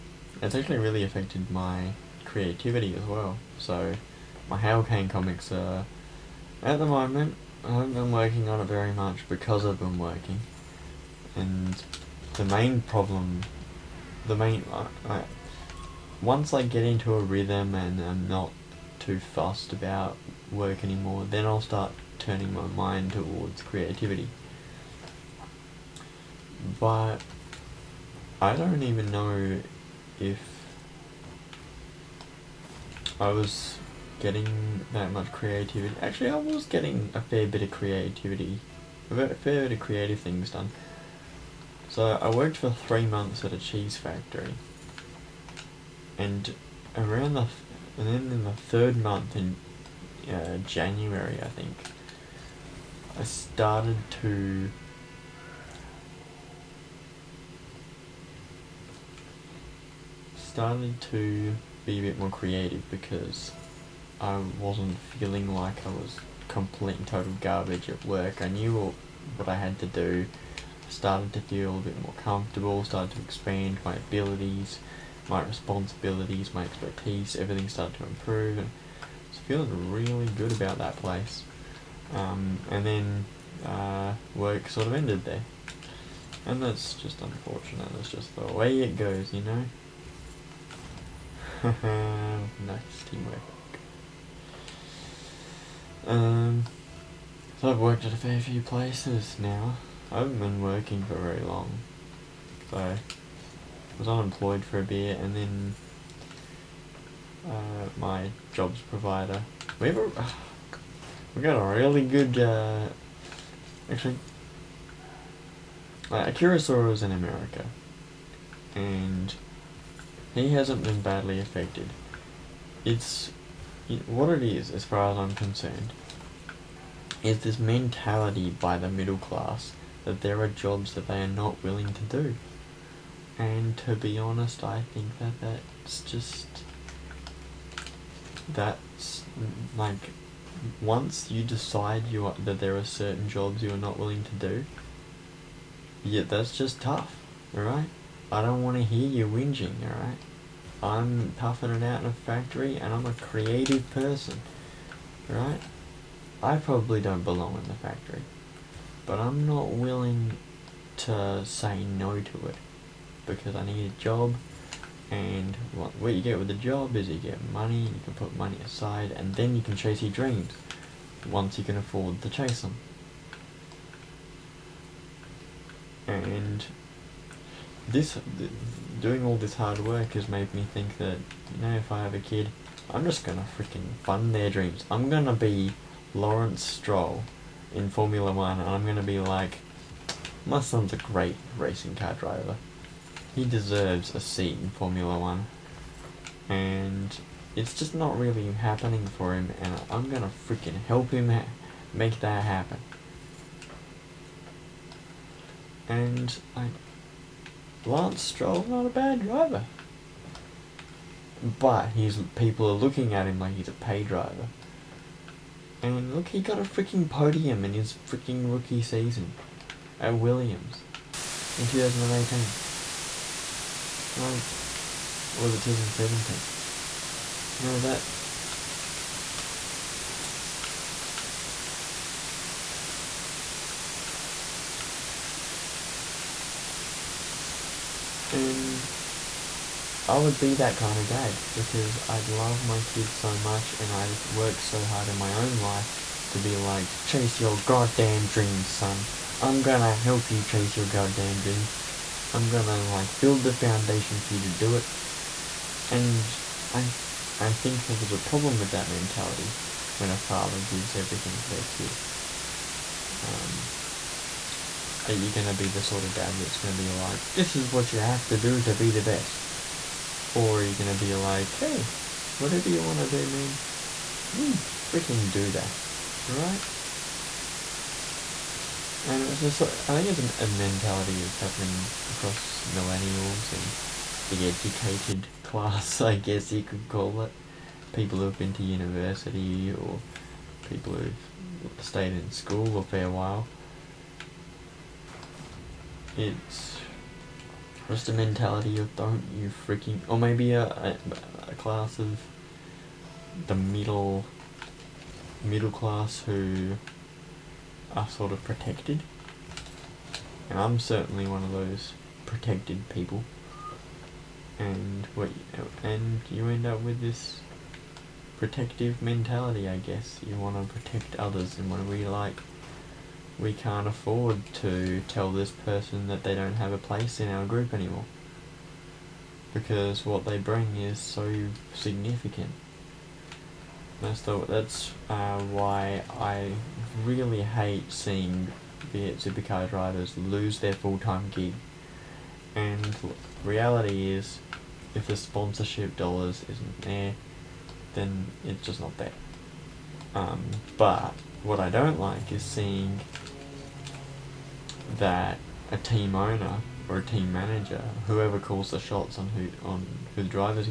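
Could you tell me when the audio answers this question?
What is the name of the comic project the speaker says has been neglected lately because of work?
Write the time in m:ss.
0:04.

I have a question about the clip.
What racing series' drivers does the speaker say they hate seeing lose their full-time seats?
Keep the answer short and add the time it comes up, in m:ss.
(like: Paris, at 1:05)
supercar, at 5:39.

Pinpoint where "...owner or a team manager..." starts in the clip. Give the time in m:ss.
5:56.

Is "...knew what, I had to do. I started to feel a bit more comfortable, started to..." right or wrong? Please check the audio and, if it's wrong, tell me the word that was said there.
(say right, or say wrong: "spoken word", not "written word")
right.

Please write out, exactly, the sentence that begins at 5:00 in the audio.
Or maybe a, a, a class of the middle middle class who are sort of protected.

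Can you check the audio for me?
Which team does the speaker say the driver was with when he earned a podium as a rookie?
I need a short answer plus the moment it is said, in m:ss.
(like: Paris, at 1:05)
Williams, at 3:40.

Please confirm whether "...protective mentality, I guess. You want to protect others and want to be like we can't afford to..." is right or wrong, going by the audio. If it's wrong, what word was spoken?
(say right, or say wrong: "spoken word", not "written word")
right.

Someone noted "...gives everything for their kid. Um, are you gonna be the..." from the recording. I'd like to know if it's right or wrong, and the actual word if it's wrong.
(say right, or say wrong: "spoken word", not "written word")
right.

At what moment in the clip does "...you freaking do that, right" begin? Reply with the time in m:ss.
4:34.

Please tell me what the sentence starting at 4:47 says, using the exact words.
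People who've been to university or people who've stayed in school a fair while.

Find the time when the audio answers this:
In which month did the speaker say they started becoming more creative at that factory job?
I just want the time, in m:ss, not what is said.
0:50.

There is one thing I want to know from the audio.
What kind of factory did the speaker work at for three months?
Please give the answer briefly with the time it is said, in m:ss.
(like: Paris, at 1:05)
cheese factory, at 0:43.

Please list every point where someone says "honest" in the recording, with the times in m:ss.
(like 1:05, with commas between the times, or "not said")
2:14.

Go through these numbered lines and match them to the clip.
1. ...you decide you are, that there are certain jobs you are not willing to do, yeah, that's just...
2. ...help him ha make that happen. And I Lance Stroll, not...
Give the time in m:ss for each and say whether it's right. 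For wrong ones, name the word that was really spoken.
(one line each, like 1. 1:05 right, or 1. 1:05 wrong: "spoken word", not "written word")
1. 2:21 right
2. 3:20 right.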